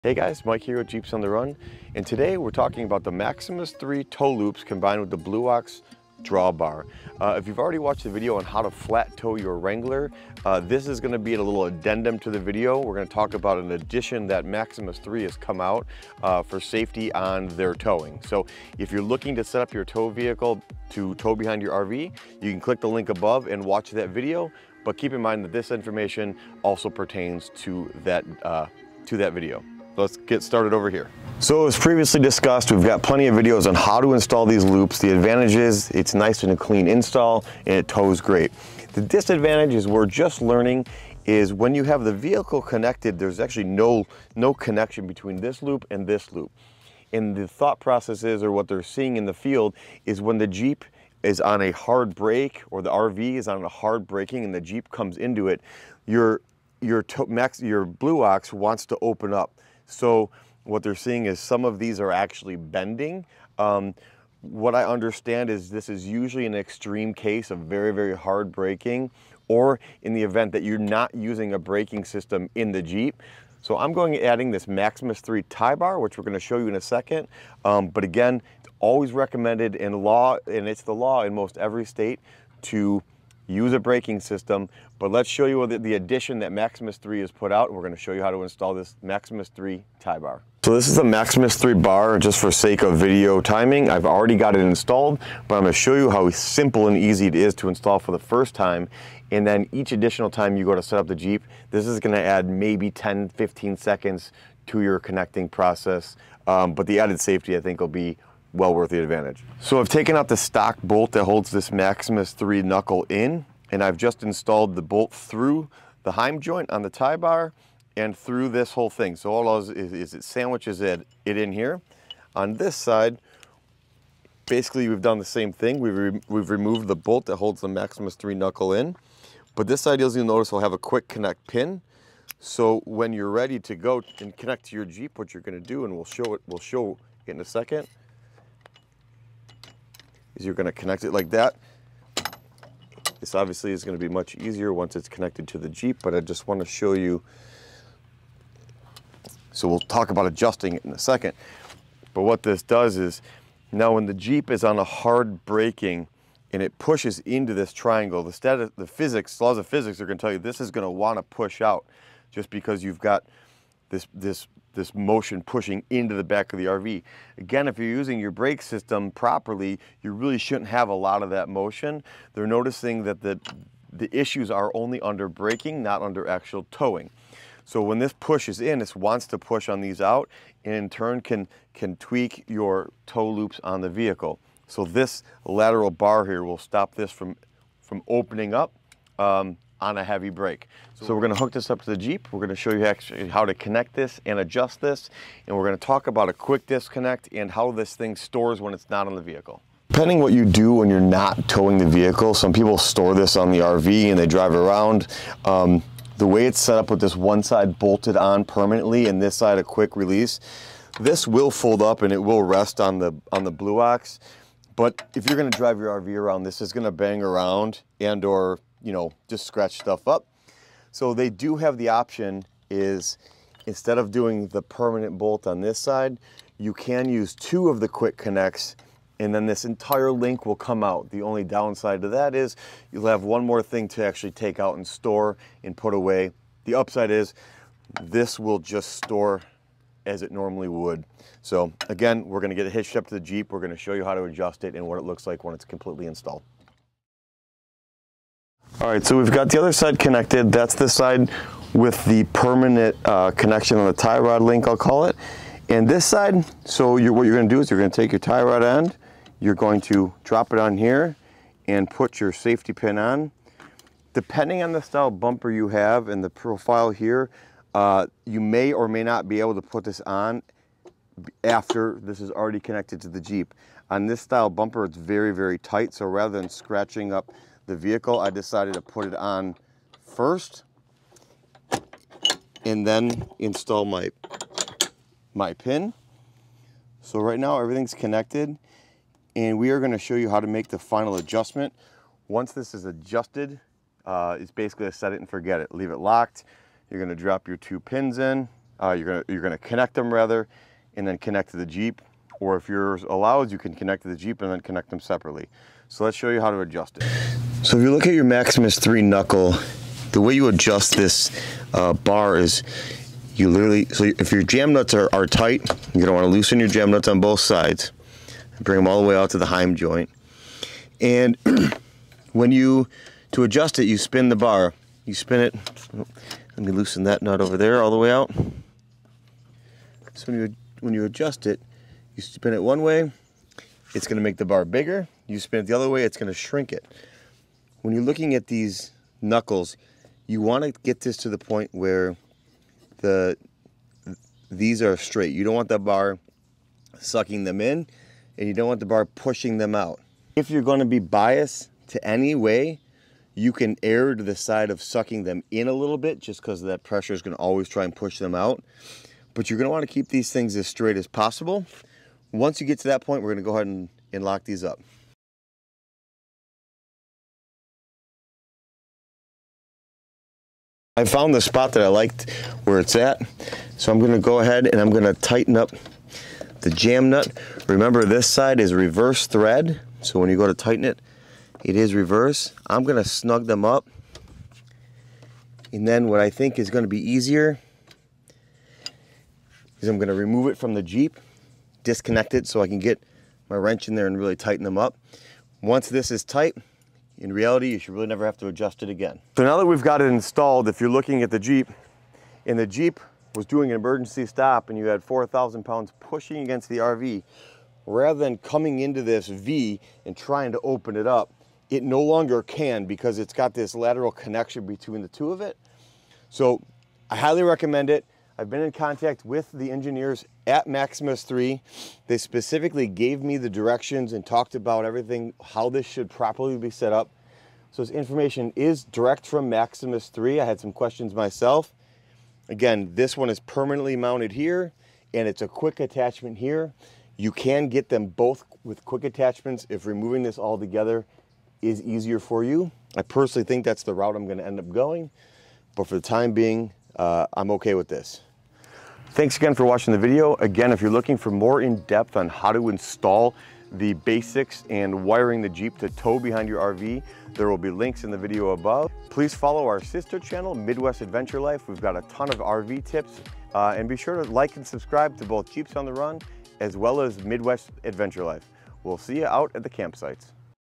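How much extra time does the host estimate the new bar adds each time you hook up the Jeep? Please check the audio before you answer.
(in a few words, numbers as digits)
10 to 15 seconds.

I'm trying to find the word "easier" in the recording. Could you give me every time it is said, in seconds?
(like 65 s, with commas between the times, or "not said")
144 s, 386 s, 441 s.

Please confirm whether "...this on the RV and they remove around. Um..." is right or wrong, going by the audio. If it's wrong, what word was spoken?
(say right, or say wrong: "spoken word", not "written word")
wrong: "drive", not "remove".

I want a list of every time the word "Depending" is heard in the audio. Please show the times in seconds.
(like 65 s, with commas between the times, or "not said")
199 s, 264 s.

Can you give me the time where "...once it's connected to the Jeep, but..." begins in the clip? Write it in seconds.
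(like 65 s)
144 s.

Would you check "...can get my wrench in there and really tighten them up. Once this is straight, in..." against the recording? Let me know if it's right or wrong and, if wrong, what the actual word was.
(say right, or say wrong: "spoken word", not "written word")
wrong: "tight", not "straight".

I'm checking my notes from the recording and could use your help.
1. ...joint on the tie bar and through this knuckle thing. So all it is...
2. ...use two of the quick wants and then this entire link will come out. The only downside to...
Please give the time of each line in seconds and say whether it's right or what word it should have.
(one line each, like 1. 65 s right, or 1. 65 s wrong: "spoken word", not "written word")
1. 116 s wrong: "whole", not "knuckle"
2. 227 s wrong: "connects", not "wants".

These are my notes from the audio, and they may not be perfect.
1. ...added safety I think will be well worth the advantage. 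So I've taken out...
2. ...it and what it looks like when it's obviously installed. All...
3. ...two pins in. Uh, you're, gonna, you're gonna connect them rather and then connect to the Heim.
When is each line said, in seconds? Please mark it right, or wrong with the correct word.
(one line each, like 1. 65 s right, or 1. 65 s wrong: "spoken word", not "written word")
1. 106 s right
2. 244 s wrong: "completely", not "obviously"
3. 297 s wrong: "Jeep", not "Heim".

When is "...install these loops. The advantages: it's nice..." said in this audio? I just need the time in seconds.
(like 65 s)
34 s.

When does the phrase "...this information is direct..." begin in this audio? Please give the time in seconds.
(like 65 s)
427 s.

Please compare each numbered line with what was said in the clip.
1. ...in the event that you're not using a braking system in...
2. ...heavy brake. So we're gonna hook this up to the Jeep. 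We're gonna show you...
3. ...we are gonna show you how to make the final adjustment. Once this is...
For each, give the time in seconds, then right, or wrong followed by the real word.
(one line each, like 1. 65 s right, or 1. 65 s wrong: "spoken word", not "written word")
1. 70 s right
2. 190 s right
3. 289 s right.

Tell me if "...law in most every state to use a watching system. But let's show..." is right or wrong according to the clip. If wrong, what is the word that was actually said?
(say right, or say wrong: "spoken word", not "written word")
wrong: "braking", not "watching".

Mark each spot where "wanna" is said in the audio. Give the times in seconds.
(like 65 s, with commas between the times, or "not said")
146 s, 160 s, 316 s.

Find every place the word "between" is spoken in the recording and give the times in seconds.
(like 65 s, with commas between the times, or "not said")
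45 s, 414 s.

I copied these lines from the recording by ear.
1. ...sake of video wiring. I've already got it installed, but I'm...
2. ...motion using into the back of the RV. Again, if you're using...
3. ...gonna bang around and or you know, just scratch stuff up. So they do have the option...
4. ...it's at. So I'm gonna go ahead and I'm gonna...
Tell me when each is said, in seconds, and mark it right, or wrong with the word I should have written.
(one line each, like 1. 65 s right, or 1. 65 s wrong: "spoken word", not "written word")
1. 92 s wrong: "timing", not "wiring"
2. 164 s wrong: "pushing", not "using"
3. 216 s right
4. 372 s right.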